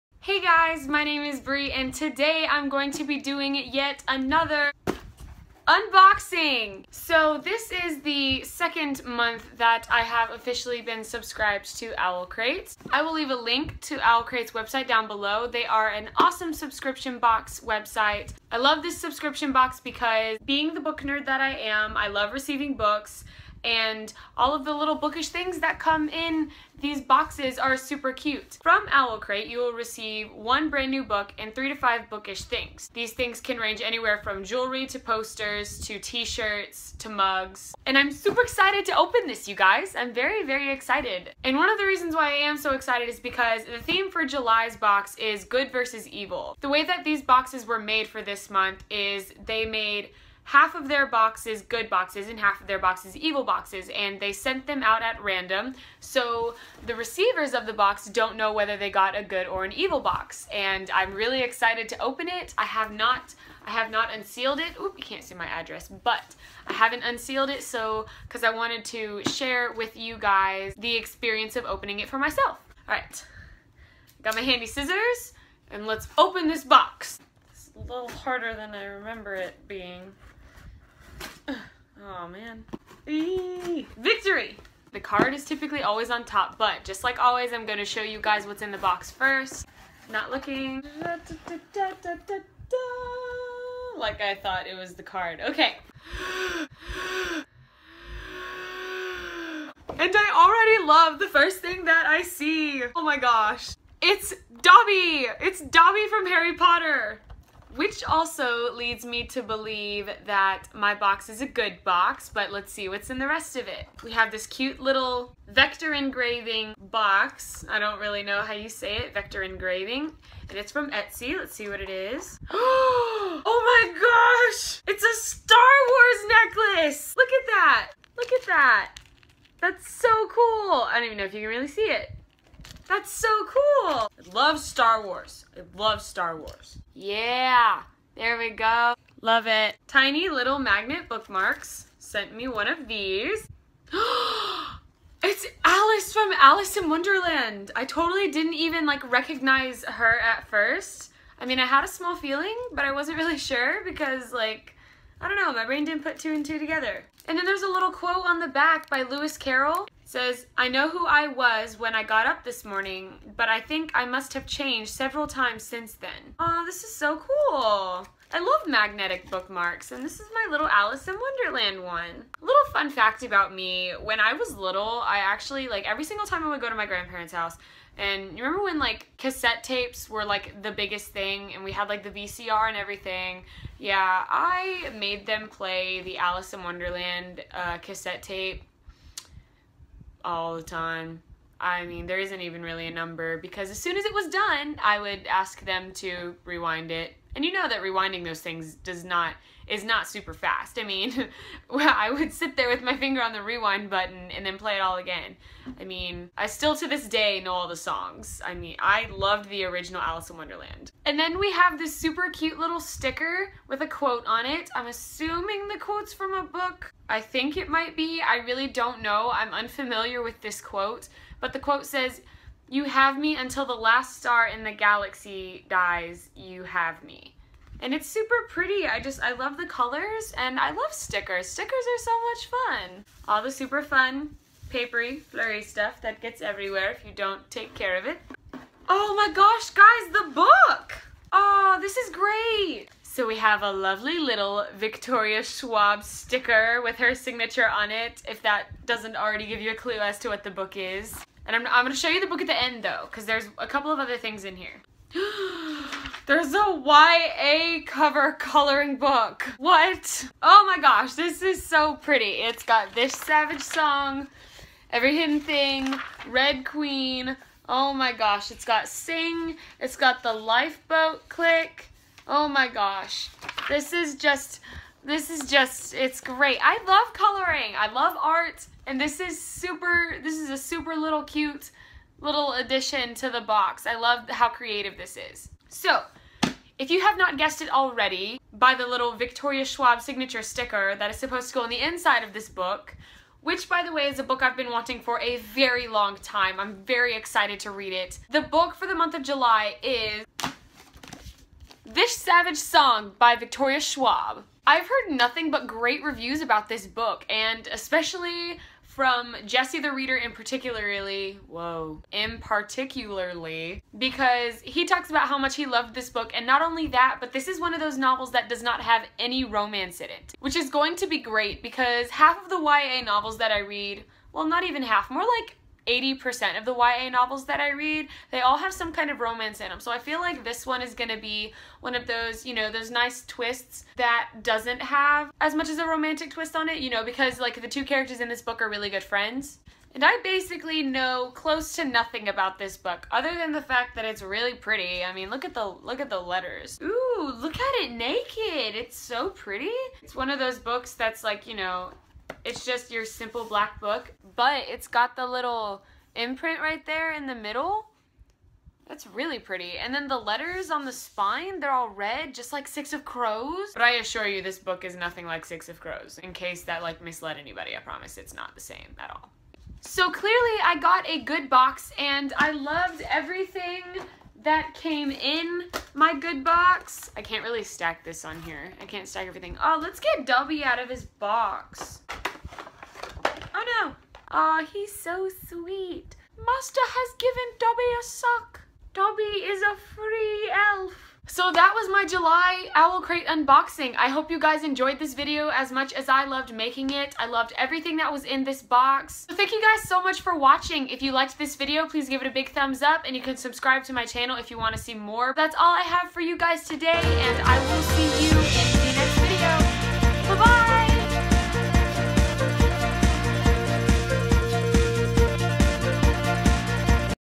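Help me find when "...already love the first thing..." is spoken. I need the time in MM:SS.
01:40.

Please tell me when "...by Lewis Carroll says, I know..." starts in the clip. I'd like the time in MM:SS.
02:38.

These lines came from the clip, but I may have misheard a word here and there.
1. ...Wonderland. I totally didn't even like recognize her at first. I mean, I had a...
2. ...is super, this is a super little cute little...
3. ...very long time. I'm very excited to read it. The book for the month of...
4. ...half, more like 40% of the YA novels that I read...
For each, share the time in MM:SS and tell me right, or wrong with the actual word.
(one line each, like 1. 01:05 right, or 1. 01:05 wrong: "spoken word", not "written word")
1. 02:26 right
2. 04:39 right
3. 04:55 right
4. 05:24 wrong: "80", not "40".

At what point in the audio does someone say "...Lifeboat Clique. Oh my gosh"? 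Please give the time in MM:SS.
04:30.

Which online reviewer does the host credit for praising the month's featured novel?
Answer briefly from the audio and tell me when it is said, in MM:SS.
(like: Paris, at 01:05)
Jesse the Reader, at 05:09.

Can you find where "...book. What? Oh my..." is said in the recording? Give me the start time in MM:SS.
04:18.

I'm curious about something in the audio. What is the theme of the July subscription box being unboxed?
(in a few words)
Good versus evil.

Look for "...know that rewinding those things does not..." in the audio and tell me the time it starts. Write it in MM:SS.
03:17.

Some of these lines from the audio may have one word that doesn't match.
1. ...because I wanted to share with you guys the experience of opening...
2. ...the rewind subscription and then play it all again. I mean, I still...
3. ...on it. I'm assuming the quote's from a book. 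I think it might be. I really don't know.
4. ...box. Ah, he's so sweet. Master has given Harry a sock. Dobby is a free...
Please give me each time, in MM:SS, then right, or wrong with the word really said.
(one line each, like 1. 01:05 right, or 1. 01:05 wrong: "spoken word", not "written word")
1. 01:08 right
2. 03:23 wrong: "button", not "subscription"
3. 03:34 right
4. 06:21 wrong: "Dobby", not "Harry".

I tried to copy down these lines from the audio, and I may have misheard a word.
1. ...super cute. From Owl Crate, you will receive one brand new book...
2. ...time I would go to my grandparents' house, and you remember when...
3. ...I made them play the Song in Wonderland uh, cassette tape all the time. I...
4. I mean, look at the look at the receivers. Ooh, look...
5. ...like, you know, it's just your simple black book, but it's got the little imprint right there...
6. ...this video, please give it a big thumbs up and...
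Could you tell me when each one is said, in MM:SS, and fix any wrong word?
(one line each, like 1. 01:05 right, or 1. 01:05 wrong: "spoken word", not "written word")
1. 00:27 right
2. 02:56 right
3. 03:04 wrong: "Alice", not "Song"
4. 05:45 wrong: "letters", not "receivers"
5. 05:51 right
6. 06:41 right.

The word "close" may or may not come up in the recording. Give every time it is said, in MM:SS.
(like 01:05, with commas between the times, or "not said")
05:41.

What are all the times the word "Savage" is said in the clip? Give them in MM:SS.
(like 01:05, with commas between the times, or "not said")
04:23, 05:02.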